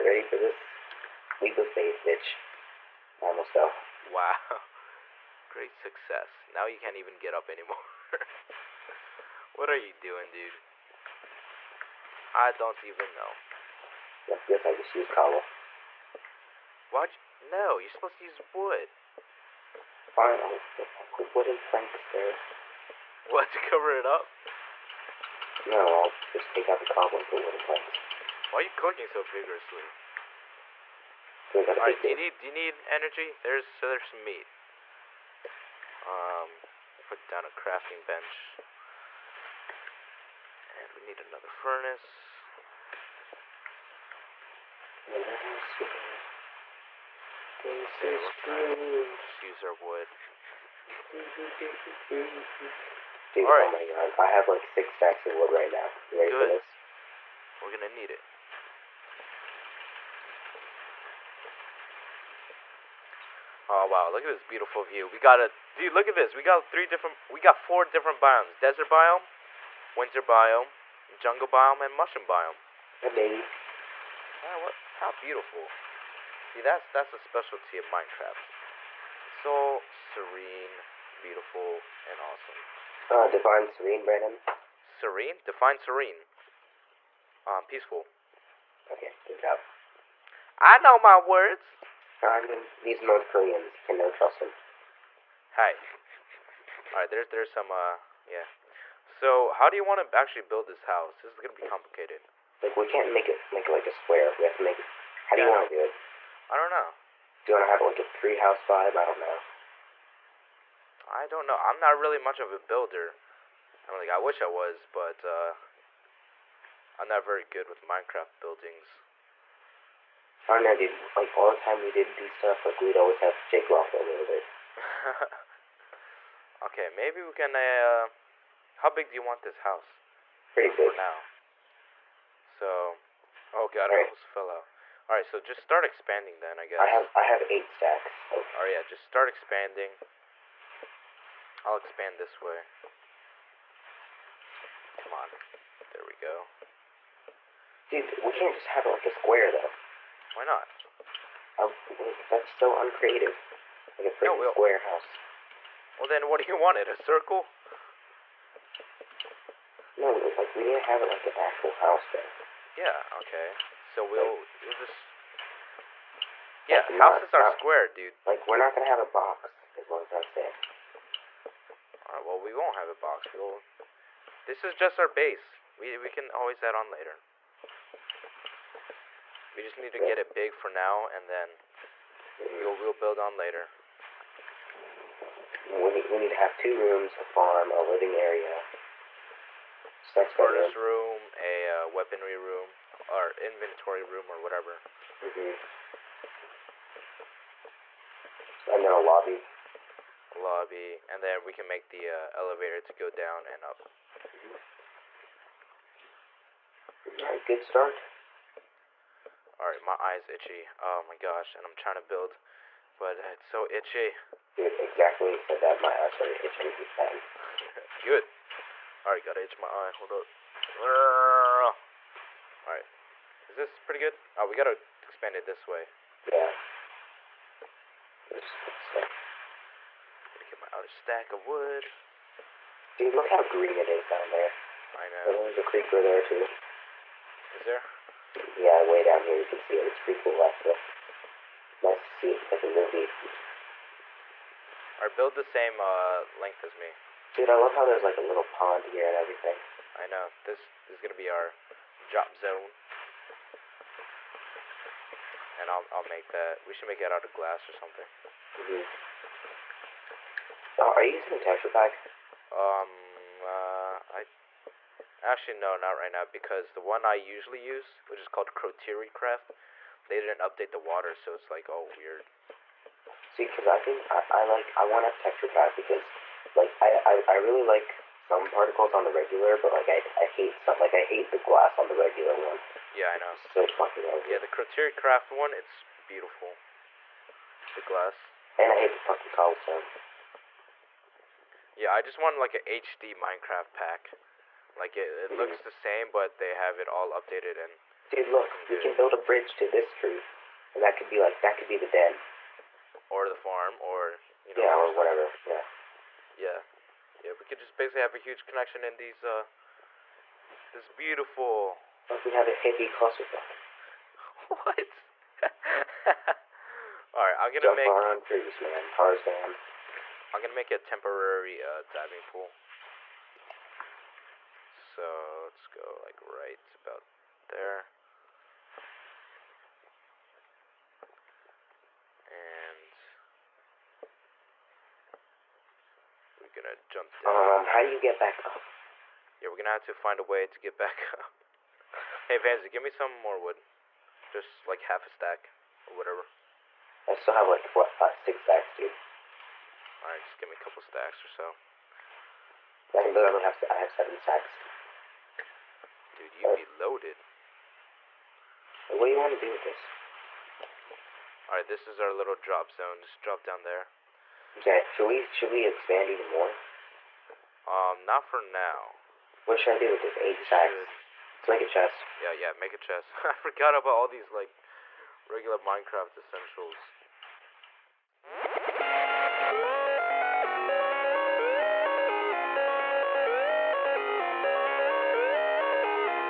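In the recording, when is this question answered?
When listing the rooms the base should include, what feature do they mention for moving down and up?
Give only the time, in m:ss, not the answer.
3:22.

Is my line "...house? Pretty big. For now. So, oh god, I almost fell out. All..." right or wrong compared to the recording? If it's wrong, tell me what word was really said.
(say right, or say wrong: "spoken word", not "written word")
right.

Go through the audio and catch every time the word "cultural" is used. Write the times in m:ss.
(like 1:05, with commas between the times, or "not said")
not said.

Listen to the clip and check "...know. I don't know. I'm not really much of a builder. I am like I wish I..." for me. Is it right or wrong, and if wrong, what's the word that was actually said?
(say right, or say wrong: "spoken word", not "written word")
right.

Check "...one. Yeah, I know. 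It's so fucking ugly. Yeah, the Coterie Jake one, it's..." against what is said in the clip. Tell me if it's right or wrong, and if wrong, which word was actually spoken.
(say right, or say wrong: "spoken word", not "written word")
wrong: "Craft", not "Jake".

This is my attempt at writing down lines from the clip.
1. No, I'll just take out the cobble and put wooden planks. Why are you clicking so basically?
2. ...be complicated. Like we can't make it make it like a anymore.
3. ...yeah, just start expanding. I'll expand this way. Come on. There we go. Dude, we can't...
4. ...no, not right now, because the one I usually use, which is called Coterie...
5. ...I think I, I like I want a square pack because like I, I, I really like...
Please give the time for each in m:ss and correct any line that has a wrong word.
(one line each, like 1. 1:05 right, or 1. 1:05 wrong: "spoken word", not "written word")
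1. 0:25 wrong: "vigorously", not "basically"
2. 1:41 wrong: "square", not "anymore"
3. 2:18 right
4. 4:25 right
5. 4:33 wrong: "texture", not "square".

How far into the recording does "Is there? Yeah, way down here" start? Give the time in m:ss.
3:57.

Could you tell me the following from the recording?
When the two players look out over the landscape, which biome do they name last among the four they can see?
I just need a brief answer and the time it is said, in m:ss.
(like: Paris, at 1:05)
mushroom biome, at 1:11.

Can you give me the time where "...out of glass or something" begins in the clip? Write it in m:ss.
4:17.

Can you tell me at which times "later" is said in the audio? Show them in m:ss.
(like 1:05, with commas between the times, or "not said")
2:56, 3:03.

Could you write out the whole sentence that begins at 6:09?
What should I do with the eight sacks?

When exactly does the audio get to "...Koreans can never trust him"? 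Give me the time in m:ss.
1:33.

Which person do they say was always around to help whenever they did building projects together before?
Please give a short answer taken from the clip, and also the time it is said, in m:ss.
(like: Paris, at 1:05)
Jake, at 2:03.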